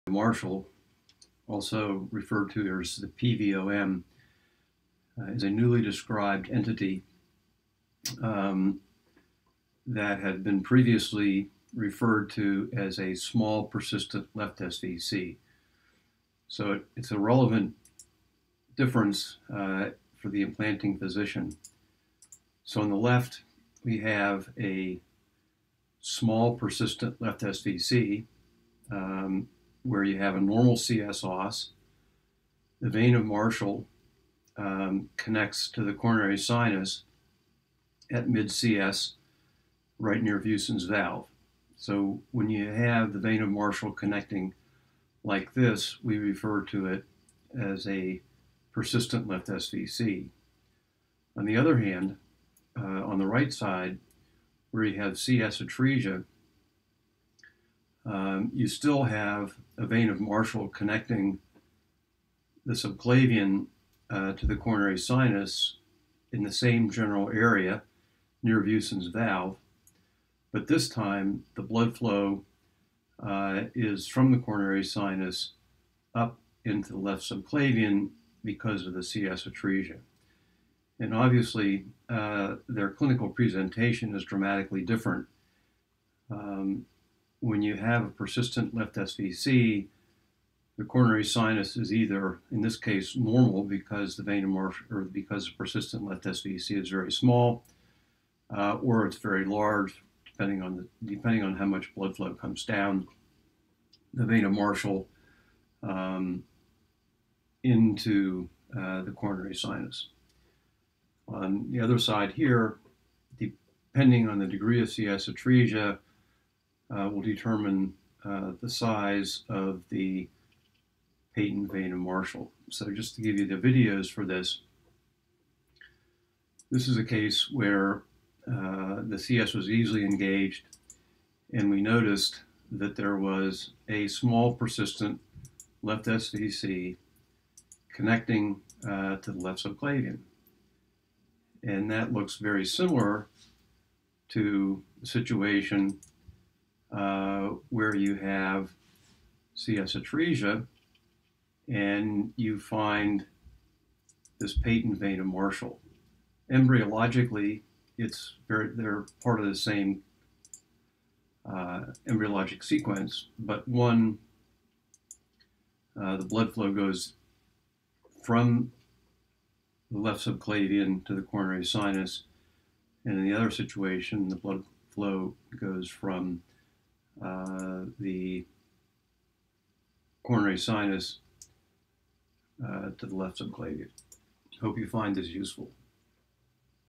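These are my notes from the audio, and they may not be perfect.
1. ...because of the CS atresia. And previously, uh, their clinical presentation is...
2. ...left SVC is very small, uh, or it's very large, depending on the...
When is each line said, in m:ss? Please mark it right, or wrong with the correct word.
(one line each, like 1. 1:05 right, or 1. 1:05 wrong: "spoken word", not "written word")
1. 1:18 wrong: "obviously", not "previously"
2. 1:36 right.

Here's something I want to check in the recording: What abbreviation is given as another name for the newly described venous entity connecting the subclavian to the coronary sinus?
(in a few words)
PVOM.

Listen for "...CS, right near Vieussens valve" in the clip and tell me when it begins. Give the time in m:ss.
0:38.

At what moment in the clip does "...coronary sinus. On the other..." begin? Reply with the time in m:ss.
1:49.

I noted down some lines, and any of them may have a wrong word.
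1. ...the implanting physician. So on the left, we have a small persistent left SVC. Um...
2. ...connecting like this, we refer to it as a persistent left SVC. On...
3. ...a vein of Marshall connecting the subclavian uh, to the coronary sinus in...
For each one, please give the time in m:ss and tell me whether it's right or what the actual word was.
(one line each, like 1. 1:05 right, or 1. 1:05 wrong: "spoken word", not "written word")
1. 0:20 right
2. 0:43 right
3. 0:59 right.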